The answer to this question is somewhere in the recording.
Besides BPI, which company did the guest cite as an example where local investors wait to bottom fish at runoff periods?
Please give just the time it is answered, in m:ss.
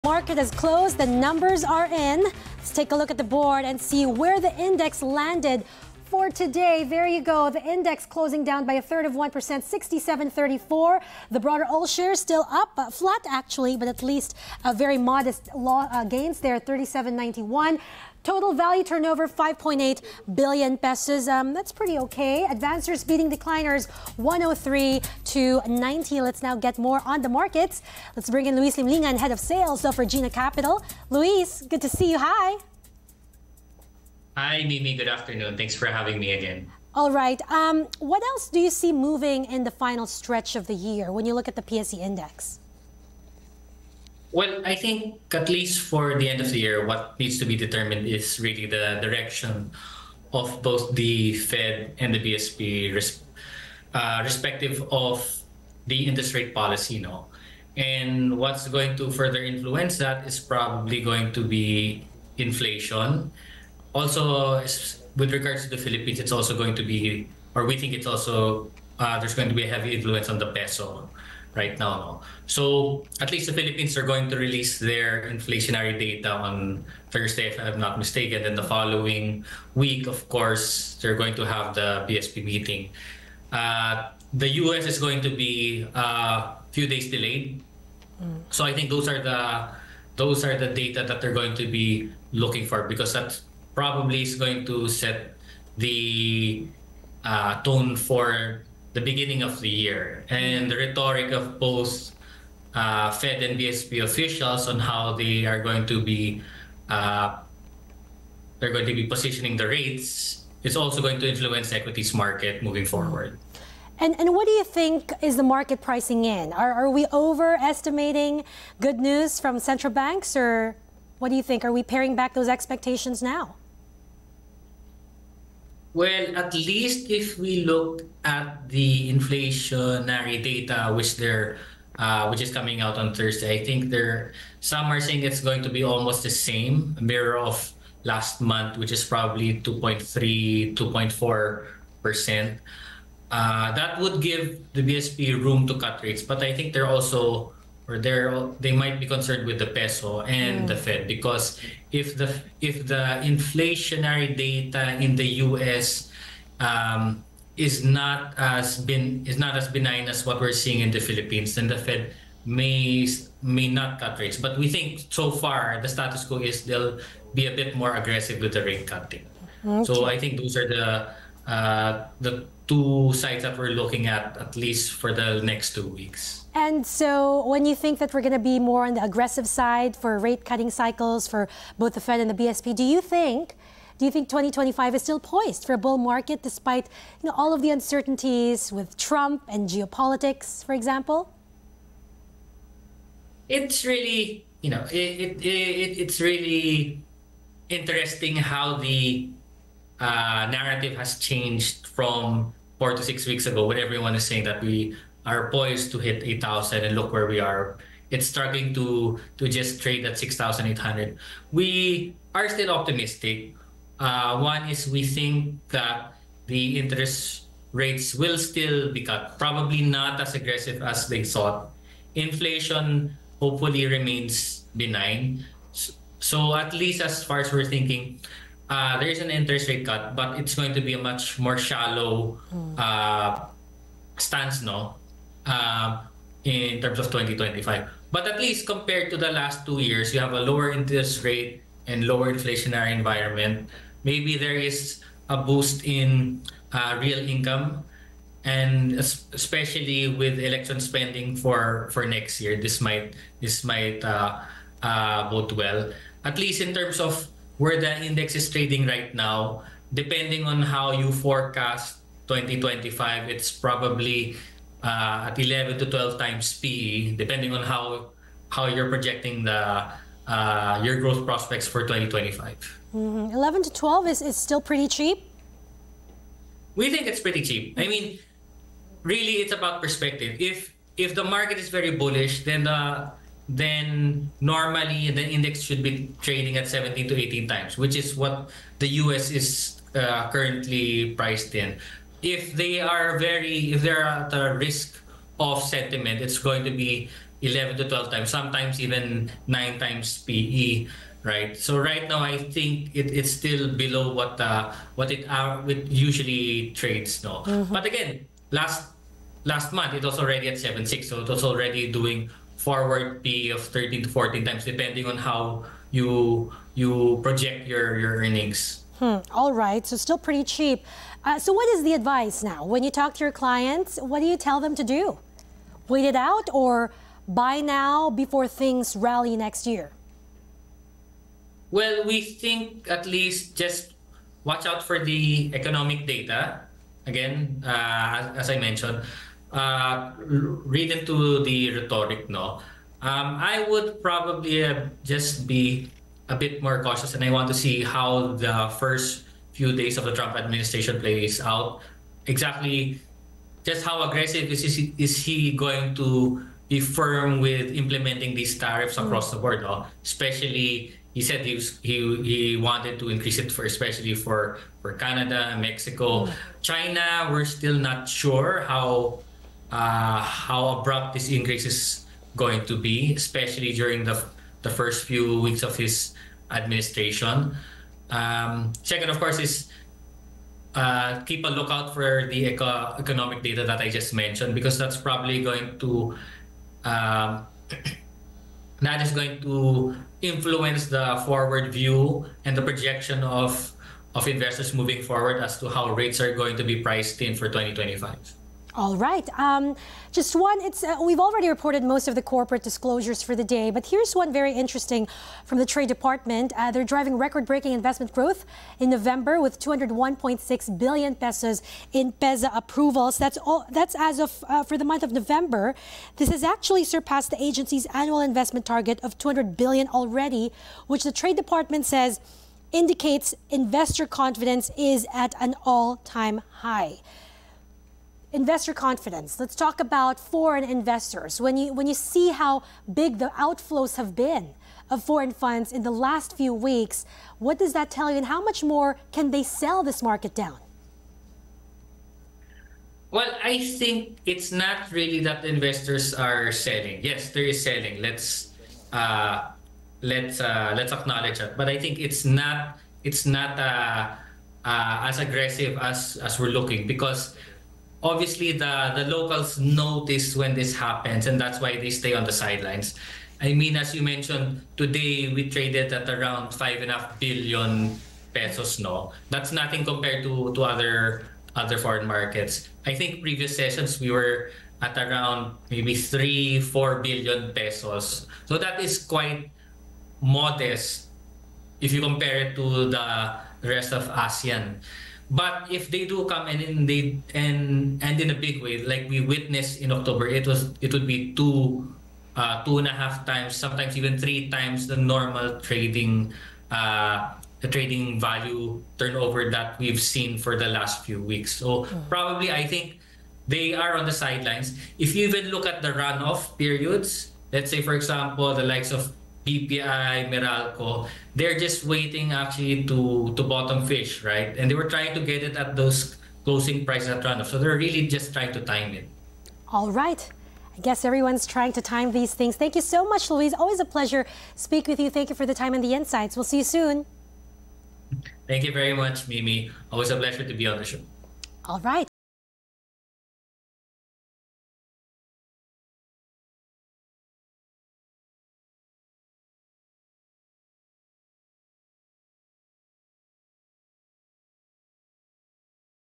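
8:30.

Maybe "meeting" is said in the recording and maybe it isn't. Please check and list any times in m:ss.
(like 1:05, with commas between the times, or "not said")
1:22.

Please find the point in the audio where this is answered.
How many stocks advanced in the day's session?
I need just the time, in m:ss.
0:24.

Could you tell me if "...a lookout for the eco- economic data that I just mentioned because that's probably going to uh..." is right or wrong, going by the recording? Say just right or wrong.
right.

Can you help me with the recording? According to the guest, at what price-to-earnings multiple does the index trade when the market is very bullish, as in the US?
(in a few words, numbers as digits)
17 to 18 times.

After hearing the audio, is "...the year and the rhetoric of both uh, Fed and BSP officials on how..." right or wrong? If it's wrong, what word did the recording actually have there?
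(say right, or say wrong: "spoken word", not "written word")
right.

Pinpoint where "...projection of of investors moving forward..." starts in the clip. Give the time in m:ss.
6:32.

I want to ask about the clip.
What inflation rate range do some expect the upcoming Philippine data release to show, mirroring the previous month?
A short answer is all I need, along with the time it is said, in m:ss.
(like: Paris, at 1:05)
2.3 to 2.4 percent, at 2:19.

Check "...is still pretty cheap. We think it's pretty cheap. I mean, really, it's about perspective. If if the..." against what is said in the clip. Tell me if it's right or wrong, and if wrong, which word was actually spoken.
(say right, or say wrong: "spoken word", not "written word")
right.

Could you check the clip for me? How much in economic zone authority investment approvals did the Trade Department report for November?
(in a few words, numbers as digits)
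201.6 billion pesos.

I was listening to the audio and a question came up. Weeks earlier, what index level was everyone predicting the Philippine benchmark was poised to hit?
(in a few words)
8,000.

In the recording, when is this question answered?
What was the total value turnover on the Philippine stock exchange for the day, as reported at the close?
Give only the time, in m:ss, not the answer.
0:19.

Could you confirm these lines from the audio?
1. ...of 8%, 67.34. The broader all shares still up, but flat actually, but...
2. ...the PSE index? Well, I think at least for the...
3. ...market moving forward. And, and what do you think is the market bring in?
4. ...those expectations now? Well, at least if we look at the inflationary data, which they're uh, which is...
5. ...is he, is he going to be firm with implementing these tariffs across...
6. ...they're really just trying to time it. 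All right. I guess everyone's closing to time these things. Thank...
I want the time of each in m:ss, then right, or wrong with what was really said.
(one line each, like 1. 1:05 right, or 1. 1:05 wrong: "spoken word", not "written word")
1. 0:09 wrong: "1", not "8"
2. 0:41 right
3. 1:52 wrong: "pricing", not "bring"
4. 2:02 right
5. 5:54 right
6. 8:37 wrong: "trying", not "closing".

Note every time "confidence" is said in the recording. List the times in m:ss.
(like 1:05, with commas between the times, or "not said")
7:04, 7:08.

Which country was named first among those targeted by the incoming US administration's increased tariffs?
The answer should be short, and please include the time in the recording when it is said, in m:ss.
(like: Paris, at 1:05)
Canada, at 6:04.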